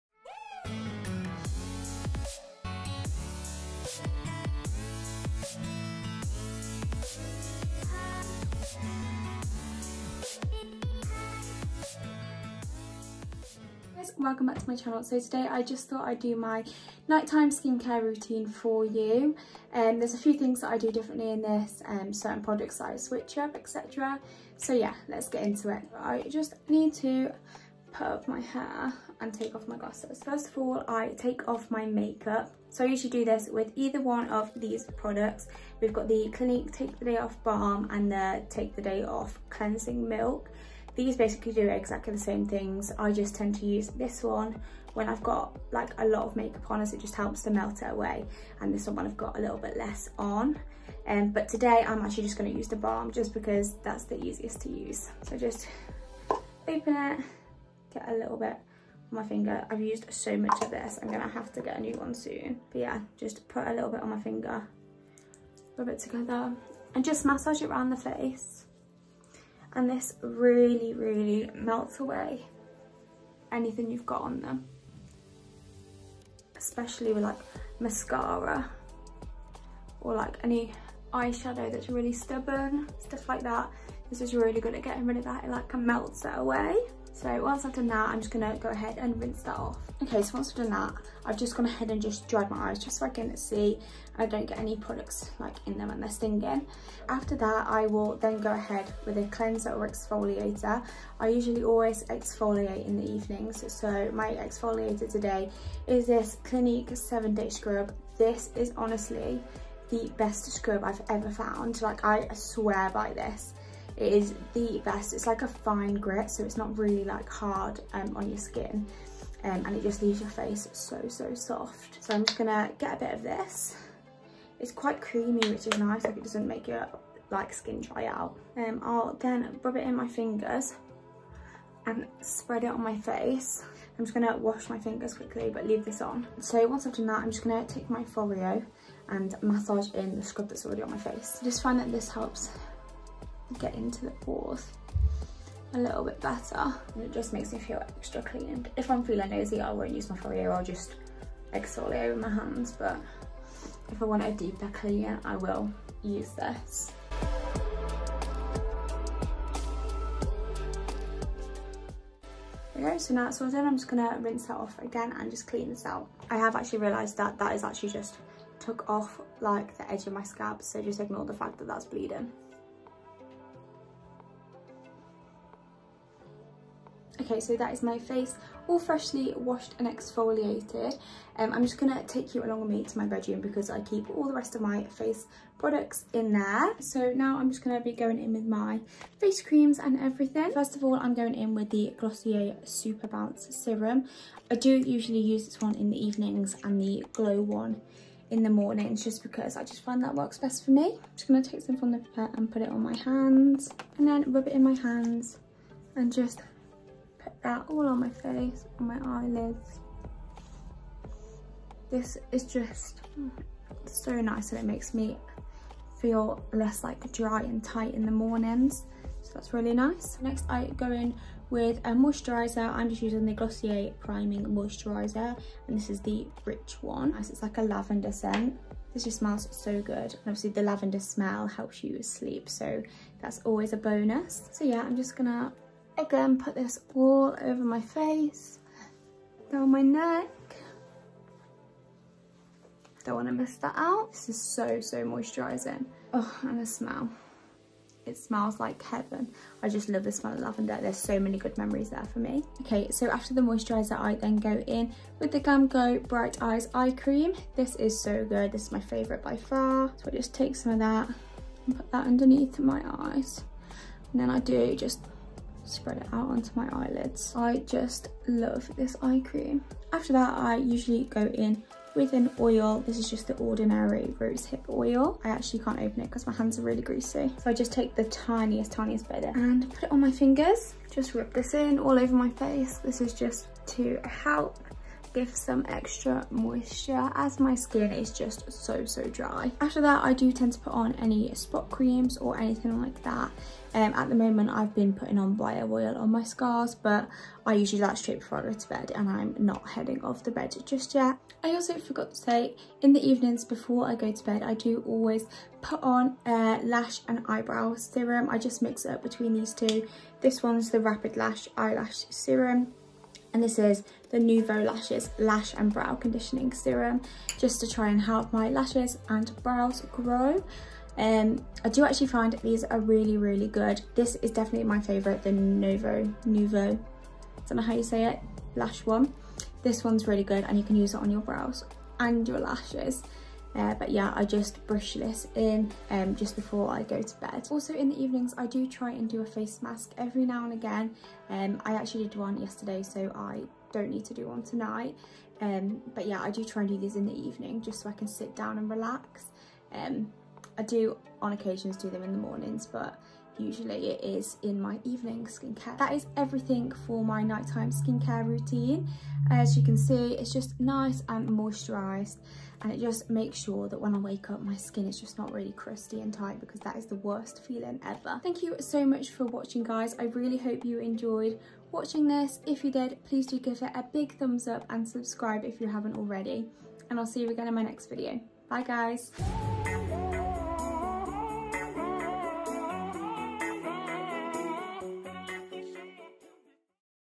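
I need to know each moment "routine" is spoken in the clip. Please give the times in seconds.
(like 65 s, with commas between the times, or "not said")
18 s, 358 s.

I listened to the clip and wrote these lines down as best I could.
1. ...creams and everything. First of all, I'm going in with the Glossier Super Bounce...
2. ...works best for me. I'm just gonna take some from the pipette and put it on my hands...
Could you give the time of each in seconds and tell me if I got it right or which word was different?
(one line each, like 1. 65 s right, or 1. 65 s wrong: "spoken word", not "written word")
1. 189 s right
2. 200 s right.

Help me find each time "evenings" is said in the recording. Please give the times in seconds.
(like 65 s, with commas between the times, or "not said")
103 s, 196 s, 303 s, 338 s, 347 s, 354 s.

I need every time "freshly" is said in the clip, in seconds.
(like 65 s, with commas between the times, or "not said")
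178 s.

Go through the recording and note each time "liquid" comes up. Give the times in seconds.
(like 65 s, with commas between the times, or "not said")
not said.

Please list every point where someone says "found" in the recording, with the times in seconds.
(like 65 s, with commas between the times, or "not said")
111 s.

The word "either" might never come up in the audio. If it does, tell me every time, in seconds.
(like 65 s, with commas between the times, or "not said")
33 s.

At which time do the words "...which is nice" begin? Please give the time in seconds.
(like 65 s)
125 s.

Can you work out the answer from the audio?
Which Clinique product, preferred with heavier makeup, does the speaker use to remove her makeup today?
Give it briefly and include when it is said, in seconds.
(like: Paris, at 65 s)
Take the Day Off Balm, at 36 s.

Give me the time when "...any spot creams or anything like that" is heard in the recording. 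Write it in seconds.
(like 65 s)
290 s.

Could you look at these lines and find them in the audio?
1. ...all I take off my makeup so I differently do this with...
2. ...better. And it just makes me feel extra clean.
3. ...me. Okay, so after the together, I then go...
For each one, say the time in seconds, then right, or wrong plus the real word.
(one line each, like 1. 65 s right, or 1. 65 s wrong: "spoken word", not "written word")
1. 30 s wrong: "usually", not "differently"
2. 146 s right
3. 252 s wrong: "moisturiser", not "together".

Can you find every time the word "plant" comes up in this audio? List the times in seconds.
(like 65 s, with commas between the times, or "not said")
not said.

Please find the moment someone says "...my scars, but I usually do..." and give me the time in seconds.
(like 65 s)
296 s.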